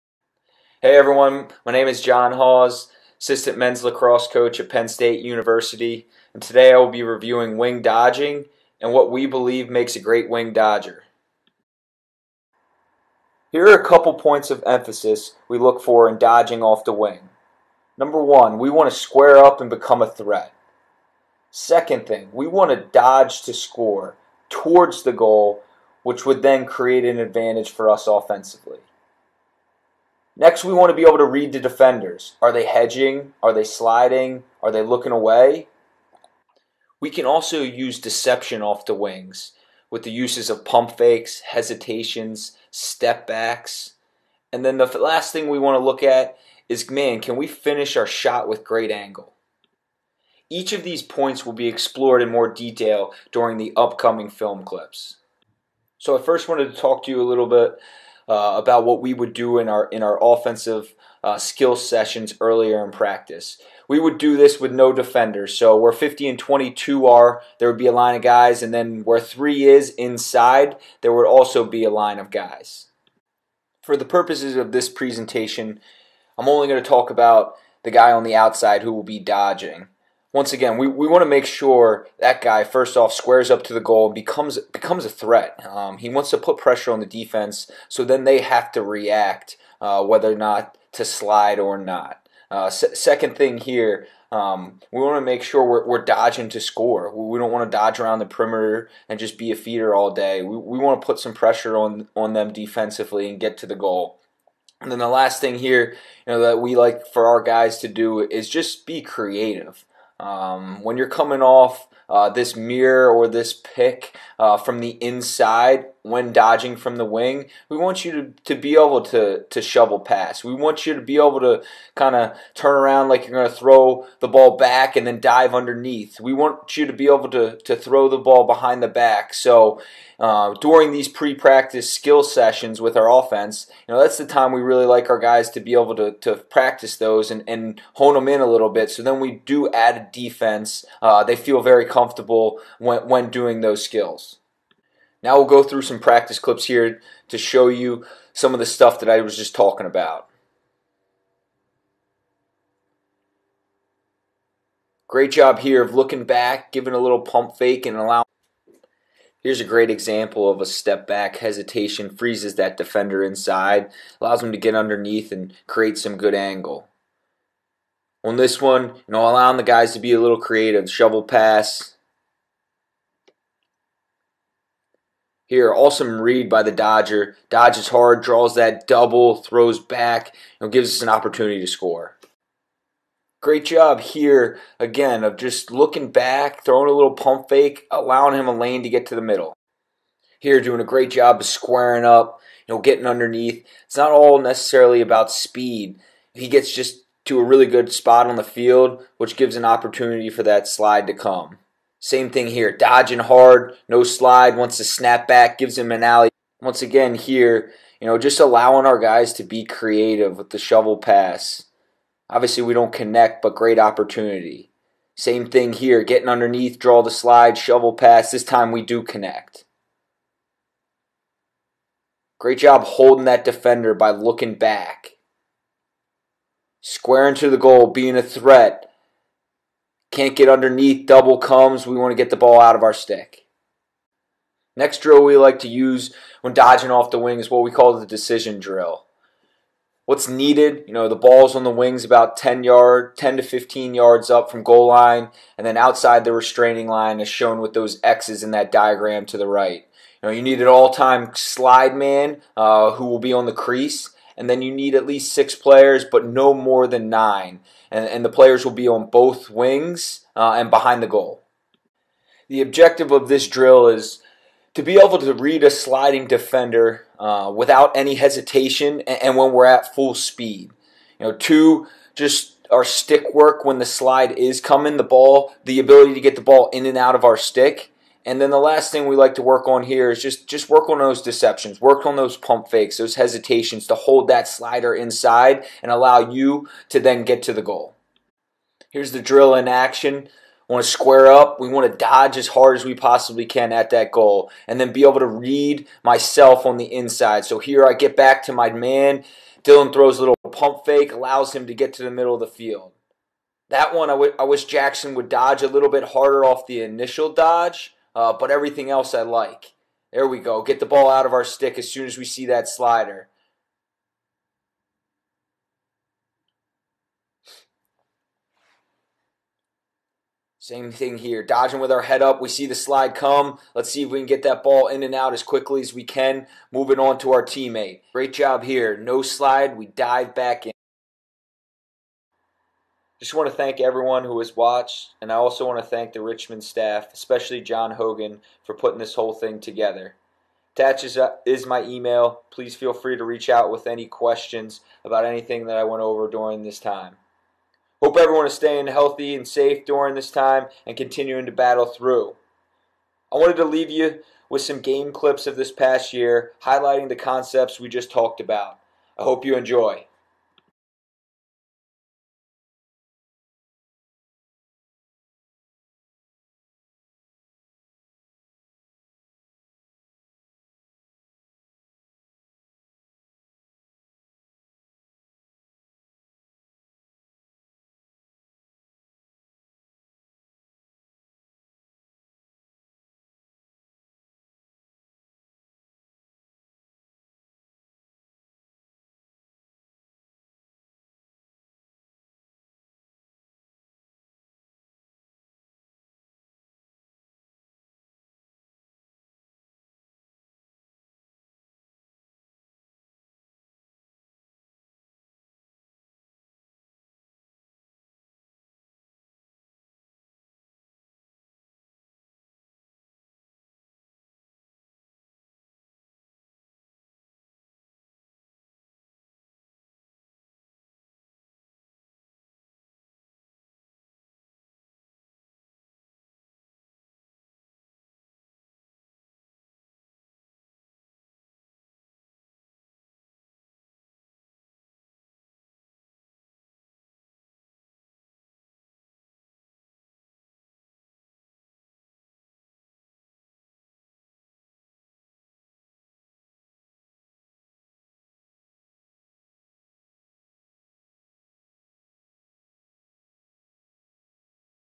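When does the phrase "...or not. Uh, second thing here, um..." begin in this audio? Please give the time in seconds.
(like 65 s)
91 s.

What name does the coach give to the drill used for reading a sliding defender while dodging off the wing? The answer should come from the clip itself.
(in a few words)
decision drill.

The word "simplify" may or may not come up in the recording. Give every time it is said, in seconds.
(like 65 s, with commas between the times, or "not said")
not said.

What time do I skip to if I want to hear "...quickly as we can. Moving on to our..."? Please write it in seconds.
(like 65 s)
325 s.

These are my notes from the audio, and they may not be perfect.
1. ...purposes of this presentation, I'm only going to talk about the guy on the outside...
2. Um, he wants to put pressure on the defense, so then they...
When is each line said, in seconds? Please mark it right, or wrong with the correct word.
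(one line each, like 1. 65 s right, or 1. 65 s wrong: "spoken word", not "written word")
1. 74 s right
2. 85 s right.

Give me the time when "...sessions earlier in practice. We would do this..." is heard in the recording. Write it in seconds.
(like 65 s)
61 s.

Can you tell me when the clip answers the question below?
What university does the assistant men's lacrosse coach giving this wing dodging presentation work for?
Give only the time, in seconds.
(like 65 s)
4 s.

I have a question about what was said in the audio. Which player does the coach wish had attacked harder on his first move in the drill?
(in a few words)
Jackson.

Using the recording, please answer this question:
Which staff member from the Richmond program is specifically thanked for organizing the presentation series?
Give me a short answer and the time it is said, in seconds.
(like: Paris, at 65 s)
John Hogan, at 337 s.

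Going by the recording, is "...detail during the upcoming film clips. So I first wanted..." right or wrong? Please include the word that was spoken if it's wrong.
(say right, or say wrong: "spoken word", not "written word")
right.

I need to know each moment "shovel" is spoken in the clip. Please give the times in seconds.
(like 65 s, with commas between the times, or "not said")
119 s, 170 s, 210 s, 217 s.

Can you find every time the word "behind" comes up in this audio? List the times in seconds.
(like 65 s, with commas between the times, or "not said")
128 s, 260 s.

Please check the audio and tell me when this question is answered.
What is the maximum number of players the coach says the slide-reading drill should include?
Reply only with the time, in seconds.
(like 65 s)
257 s.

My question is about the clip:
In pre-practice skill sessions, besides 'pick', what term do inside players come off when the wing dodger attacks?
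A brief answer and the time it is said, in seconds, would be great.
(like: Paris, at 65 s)
mirror, at 112 s.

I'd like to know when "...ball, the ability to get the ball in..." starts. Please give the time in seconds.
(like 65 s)
275 s.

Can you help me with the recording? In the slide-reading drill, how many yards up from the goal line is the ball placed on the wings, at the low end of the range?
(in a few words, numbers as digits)
10.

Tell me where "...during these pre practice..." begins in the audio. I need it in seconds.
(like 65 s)
130 s.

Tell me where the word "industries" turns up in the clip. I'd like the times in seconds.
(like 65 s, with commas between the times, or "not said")
not said.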